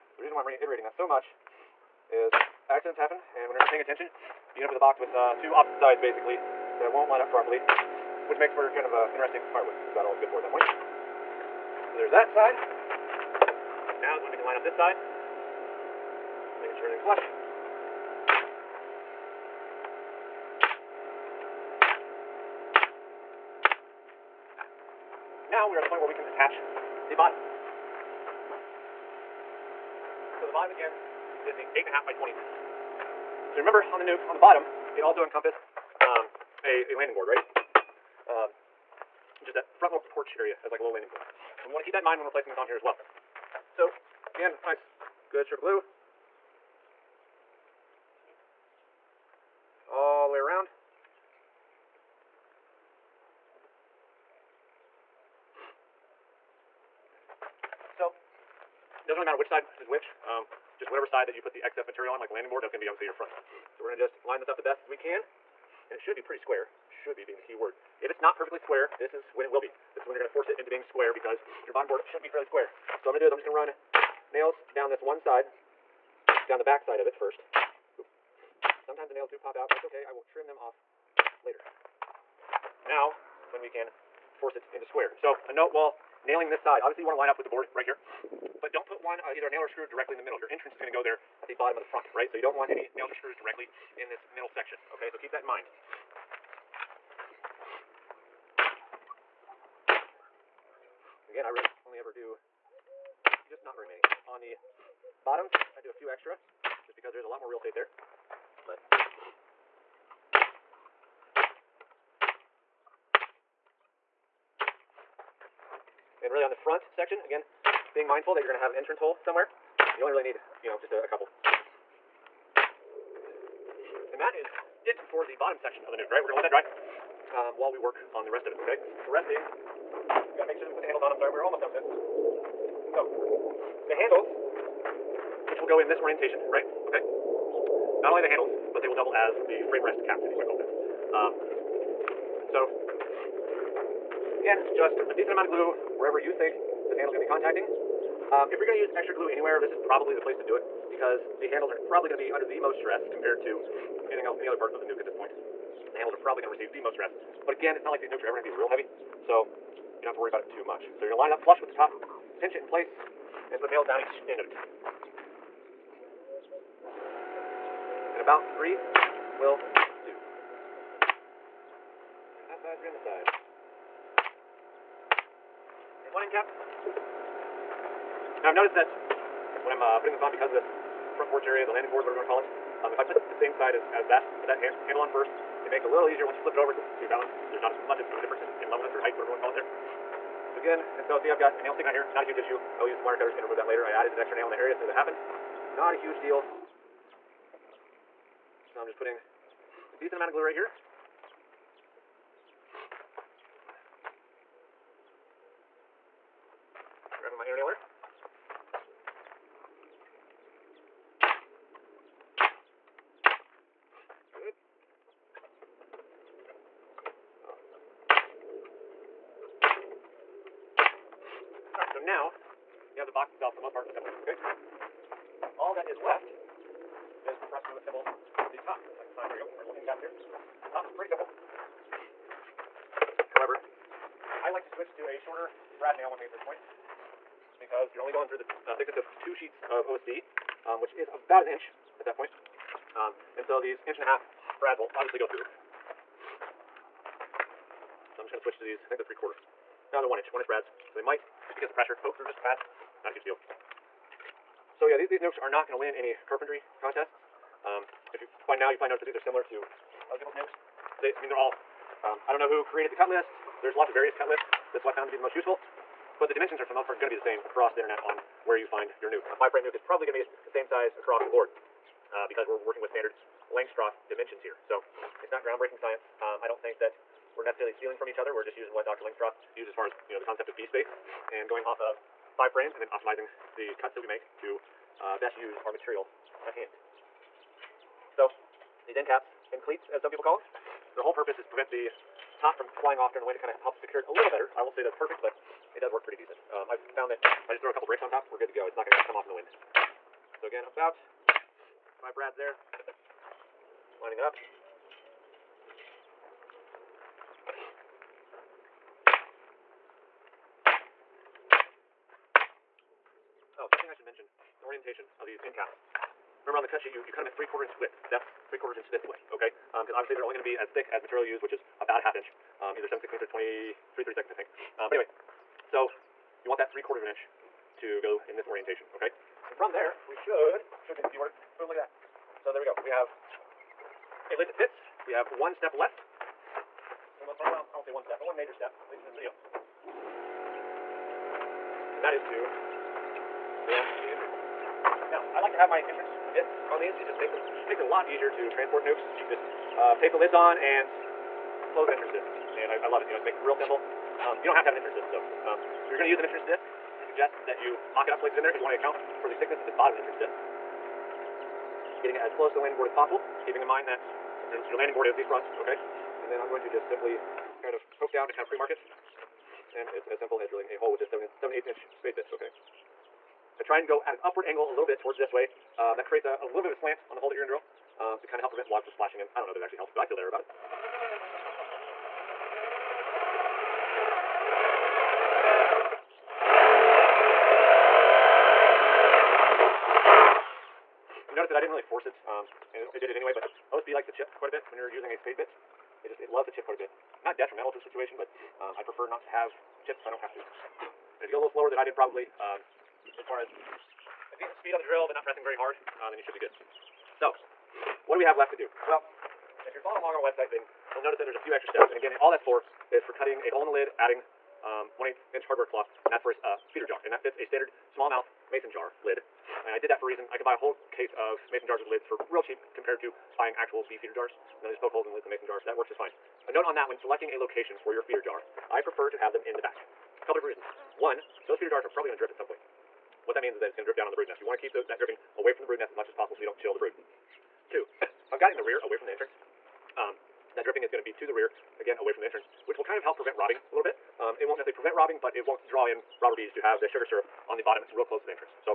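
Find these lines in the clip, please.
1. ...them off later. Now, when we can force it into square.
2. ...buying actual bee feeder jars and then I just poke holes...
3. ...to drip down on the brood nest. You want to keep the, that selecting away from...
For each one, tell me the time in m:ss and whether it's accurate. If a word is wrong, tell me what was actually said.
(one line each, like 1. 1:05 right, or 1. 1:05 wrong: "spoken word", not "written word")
1. 1:20 right
2. 7:03 right
3. 7:13 wrong: "dripping", not "selecting".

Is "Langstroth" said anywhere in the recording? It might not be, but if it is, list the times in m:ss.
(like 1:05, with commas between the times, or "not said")
4:33, 4:39.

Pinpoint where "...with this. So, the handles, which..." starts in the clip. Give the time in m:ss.
2:11.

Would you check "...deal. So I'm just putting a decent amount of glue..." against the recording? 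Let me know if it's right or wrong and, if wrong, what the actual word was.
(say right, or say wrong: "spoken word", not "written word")
right.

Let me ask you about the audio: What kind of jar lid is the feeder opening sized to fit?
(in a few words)
smallmouth mason jar lid.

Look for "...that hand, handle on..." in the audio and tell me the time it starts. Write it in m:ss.
3:04.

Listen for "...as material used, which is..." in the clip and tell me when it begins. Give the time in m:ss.
5:20.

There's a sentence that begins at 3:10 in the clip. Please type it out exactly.
So again, and so see I've got a nail sticking out here, not a huge issue.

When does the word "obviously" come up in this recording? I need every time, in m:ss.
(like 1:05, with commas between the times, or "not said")
1:02, 1:26, 4:04, 5:19.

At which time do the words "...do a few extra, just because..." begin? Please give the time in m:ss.
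1:45.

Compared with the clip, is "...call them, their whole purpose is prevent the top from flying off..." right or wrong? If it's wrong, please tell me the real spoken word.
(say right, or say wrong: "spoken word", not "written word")
right.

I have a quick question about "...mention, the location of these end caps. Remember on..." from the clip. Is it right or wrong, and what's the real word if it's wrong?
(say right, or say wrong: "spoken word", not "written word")
wrong: "orientation", not "location".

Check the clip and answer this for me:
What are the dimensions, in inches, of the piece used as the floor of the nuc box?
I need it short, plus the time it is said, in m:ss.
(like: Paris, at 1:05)
8.5 by 20, at 0:31.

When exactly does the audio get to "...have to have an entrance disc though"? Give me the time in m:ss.
5:54.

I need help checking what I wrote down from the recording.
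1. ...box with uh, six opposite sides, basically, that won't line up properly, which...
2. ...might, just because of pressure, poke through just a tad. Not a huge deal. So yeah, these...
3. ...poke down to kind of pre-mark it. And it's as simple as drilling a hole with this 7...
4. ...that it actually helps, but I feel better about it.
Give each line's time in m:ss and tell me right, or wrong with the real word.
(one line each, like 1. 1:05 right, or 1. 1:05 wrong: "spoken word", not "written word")
1. 0:04 wrong: "two", not "six"
2. 4:11 right
3. 6:07 right
4. 6:19 right.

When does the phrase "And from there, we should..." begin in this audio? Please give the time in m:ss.
5:29.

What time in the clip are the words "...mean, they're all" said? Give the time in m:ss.
4:21.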